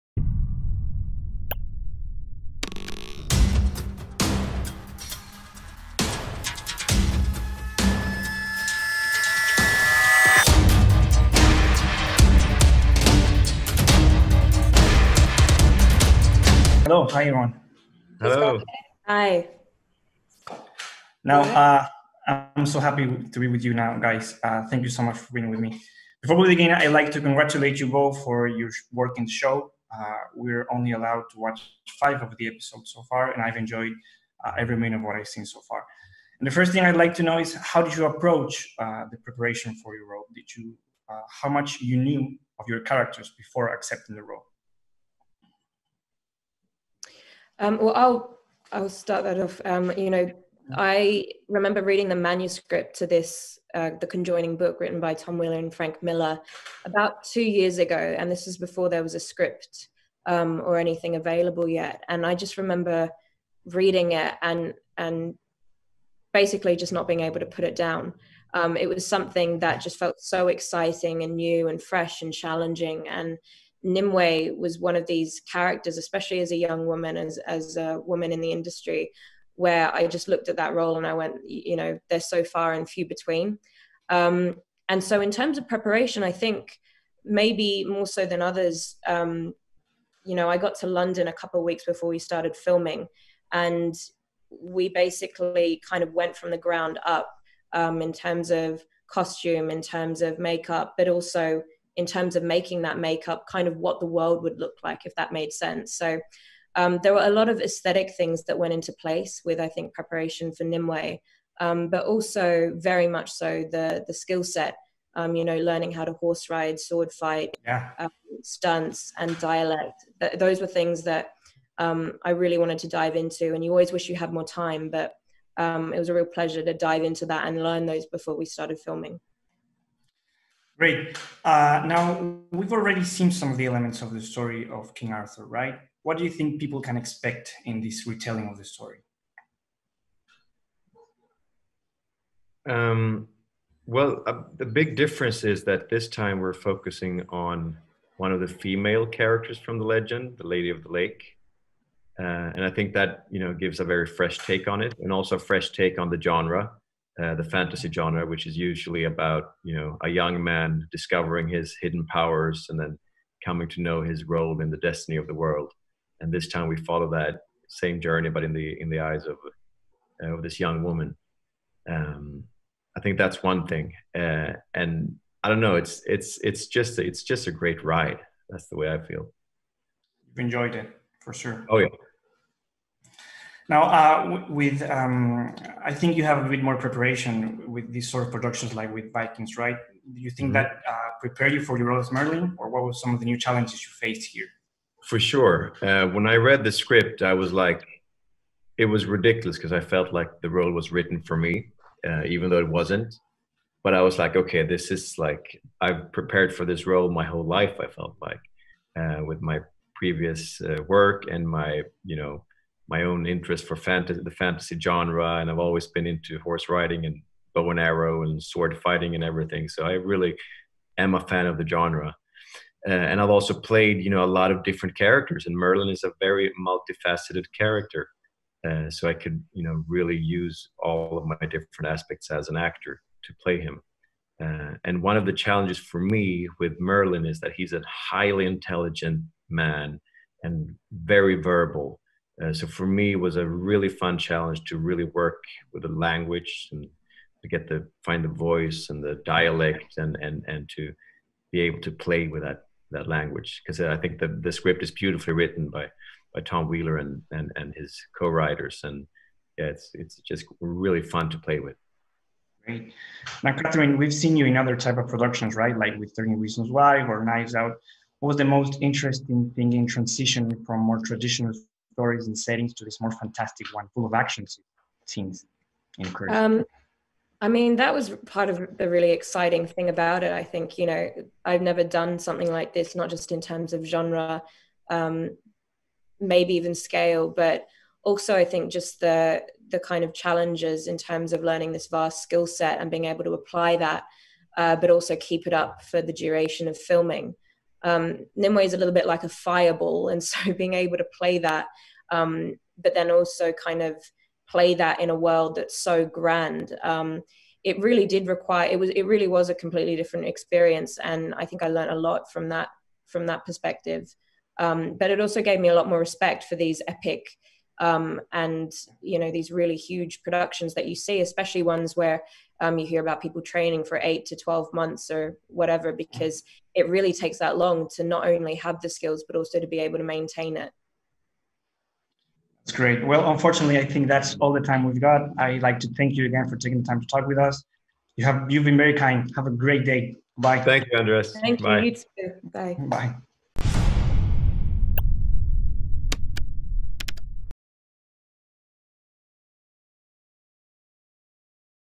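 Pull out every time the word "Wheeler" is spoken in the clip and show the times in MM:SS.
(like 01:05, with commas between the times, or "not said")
00:55, 04:16.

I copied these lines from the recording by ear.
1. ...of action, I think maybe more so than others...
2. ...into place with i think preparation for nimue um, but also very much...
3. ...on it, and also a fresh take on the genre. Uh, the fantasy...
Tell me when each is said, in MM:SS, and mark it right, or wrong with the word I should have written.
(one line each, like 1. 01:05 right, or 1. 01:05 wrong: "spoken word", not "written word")
1. 01:25 wrong: "preparation", not "action"
2. 01:48 right
3. 02:34 right.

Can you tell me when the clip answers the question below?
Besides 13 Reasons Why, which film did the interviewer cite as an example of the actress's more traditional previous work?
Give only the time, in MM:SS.
04:27.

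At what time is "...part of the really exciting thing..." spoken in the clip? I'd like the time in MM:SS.
04:38.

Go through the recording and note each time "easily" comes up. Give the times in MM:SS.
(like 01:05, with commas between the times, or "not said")
not said.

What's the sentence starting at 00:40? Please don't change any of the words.
Did you, uh, how much you knew of your characters before accepting the role?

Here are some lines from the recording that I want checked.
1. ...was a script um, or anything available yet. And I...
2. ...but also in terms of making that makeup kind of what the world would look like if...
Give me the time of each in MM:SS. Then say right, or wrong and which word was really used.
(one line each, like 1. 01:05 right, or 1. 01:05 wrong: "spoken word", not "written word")
1. 00:59 right
2. 01:40 right.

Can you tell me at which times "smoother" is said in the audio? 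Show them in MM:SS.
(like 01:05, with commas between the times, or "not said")
not said.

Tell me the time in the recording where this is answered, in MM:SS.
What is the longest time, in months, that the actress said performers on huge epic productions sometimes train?
05:24.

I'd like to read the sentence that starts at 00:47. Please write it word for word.
Um, well, I'll I'll start that off.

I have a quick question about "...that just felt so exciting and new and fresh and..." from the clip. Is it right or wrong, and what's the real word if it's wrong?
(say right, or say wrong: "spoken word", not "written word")
right.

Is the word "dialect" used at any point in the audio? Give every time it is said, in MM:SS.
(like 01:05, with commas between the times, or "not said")
01:59, 04:09.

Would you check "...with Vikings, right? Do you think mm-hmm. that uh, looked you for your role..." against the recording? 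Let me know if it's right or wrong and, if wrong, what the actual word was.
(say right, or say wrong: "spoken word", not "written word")
wrong: "prepared", not "looked".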